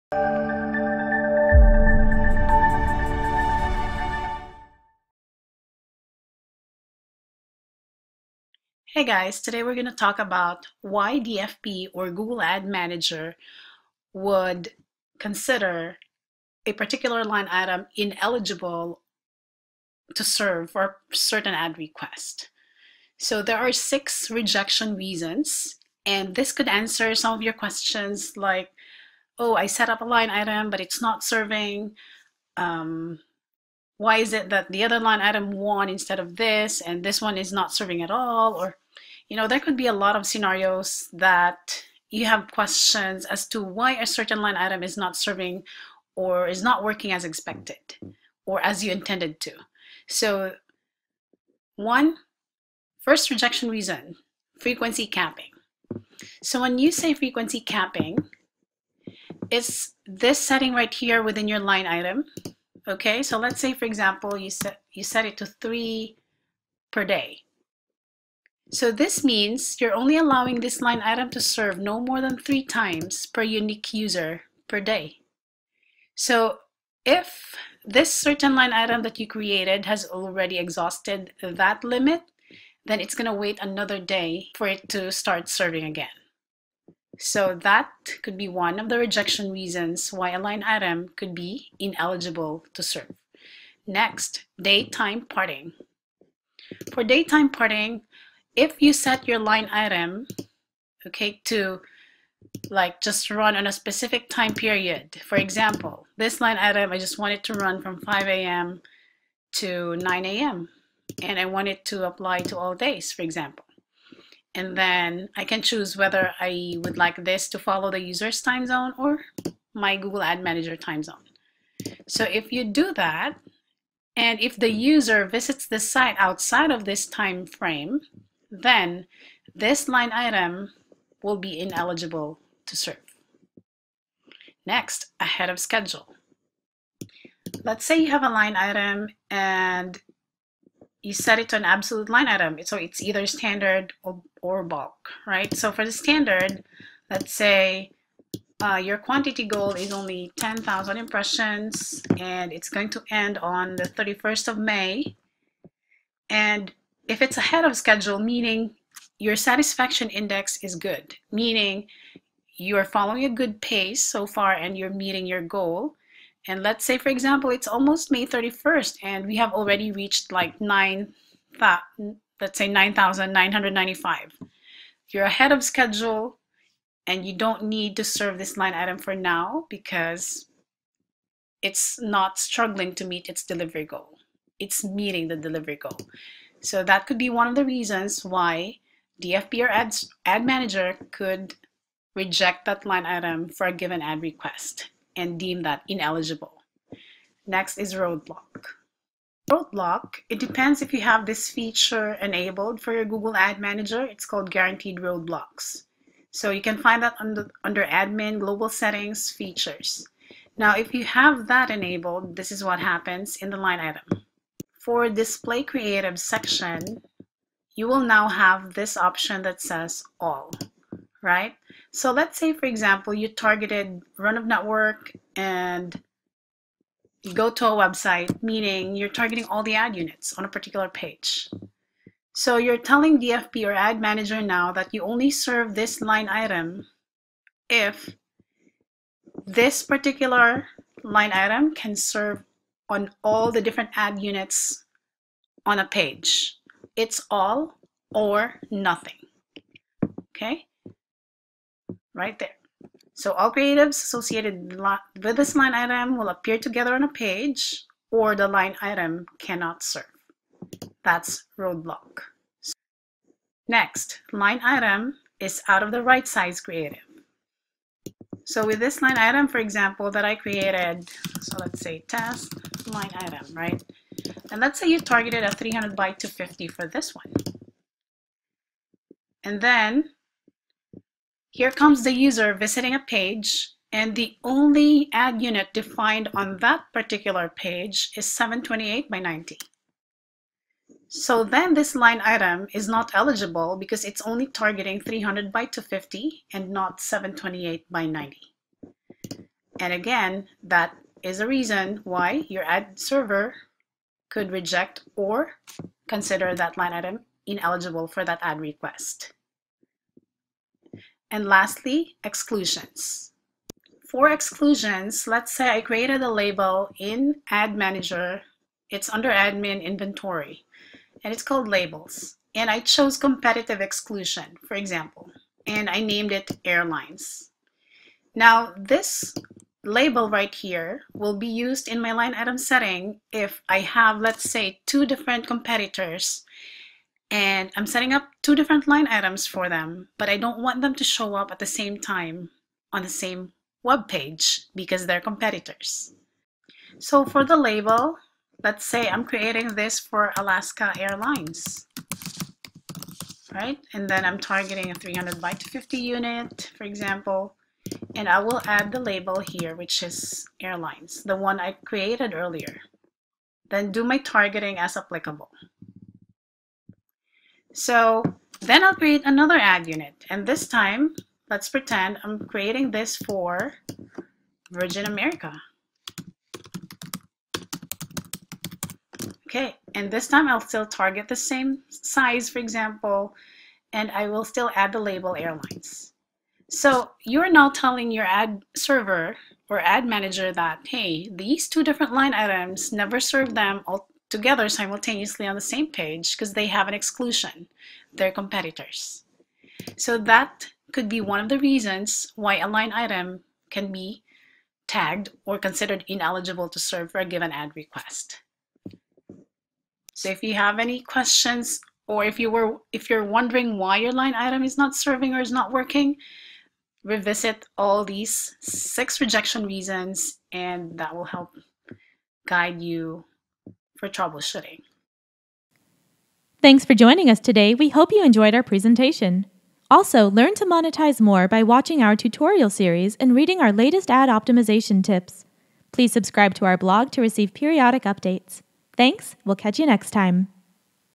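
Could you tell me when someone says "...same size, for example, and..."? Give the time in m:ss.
6:21.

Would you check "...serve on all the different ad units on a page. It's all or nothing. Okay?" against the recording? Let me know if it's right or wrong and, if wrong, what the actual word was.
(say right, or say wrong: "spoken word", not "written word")
right.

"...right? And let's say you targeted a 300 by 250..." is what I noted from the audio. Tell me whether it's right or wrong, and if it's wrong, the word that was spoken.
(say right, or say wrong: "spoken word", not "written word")
right.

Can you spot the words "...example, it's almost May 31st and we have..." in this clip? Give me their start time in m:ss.
2:47.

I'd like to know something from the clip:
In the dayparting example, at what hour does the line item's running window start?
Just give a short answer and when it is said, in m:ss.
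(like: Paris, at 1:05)
5 a.m., at 1:48.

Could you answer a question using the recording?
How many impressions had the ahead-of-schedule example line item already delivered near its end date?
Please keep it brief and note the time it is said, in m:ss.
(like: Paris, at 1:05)
9,995, at 2:52.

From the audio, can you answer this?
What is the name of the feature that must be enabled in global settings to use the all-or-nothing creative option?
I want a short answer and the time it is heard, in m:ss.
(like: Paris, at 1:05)
Guaranteed roadblocks, at 3:24.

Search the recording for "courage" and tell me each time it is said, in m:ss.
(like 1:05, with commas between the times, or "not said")
not said.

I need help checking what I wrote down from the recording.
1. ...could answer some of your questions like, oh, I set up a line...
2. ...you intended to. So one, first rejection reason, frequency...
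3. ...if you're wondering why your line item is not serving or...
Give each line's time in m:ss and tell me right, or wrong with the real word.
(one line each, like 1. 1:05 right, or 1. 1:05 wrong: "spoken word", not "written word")
1. 0:26 right
2. 0:48 right
3. 6:52 right.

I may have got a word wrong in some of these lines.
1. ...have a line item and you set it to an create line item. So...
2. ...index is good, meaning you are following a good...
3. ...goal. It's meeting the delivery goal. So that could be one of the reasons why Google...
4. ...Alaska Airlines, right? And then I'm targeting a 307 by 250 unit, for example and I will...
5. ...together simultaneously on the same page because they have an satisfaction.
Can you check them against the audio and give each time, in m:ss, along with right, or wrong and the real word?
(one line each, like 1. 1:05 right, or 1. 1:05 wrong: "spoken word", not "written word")
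1. 2:18 wrong: "absolute", not "create"
2. 2:40 right
3. 3:03 wrong: "DFP", not "Google"
4. 5:50 wrong: "300", not "307"
5. 6:34 wrong: "exclusion", not "satisfaction".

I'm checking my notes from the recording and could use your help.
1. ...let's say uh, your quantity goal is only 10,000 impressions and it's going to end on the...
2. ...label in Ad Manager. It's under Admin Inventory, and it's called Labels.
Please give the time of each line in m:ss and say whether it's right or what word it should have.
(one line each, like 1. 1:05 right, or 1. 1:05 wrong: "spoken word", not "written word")
1. 2:27 right
2. 5:16 right.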